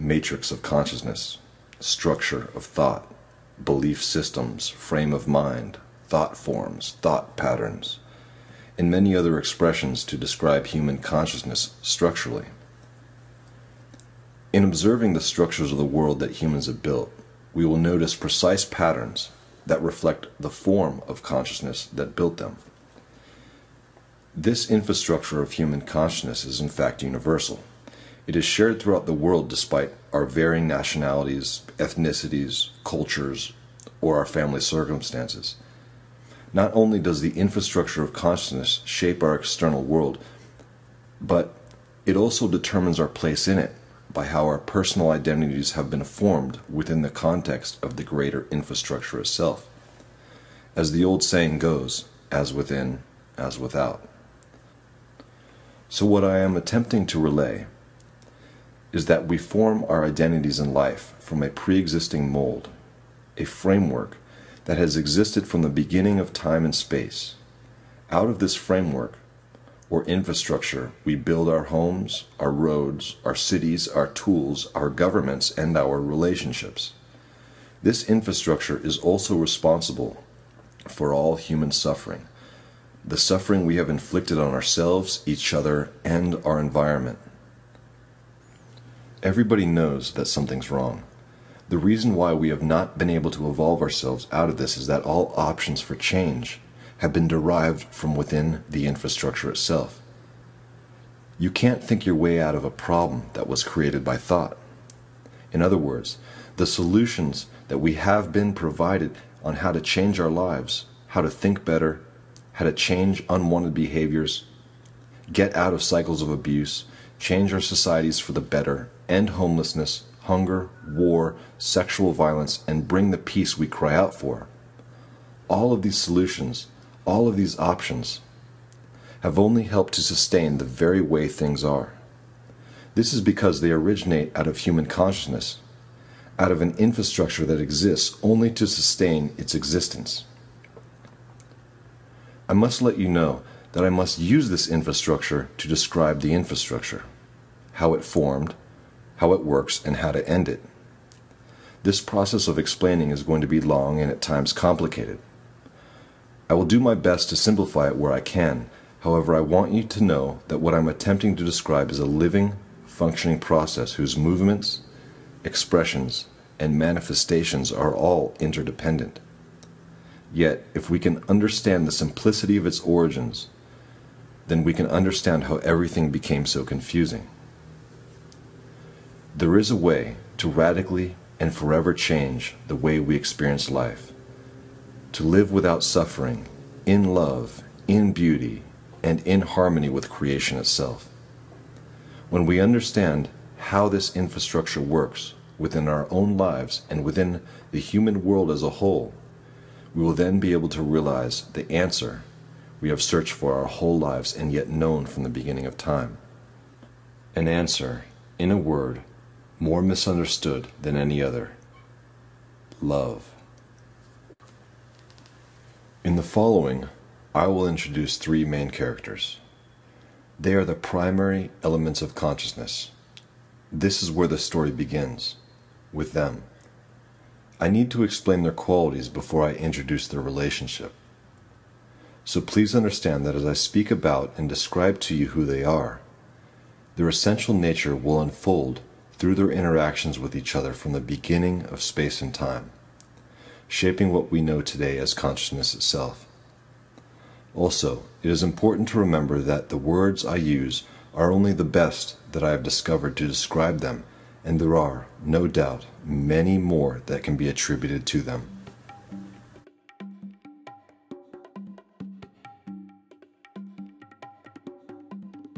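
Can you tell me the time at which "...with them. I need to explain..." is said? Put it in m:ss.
3:45.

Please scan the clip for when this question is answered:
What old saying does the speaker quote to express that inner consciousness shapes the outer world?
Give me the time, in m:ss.
0:52.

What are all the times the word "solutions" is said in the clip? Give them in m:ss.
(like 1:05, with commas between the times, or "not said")
1:46, 2:05.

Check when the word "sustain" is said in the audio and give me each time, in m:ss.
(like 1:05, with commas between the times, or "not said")
2:10, 2:18.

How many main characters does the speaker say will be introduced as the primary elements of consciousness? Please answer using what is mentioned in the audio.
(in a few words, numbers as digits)
3.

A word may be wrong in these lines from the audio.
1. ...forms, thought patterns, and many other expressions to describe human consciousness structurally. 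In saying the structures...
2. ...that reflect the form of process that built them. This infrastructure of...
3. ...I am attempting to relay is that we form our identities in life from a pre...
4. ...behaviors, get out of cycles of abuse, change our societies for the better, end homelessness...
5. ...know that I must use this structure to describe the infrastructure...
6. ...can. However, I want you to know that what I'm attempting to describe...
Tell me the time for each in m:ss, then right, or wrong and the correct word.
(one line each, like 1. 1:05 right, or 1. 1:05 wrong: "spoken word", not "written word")
1. 0:06 wrong: "observing", not "saying"
2. 0:19 wrong: "consciousness", not "process"
3. 0:56 right
4. 1:53 right
5. 2:23 wrong: "infrastructure", not "structure"
6. 2:38 right.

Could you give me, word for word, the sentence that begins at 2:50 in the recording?
Yet, if we can understand the simplicity of its origins, then we can understand how everything became so confusing.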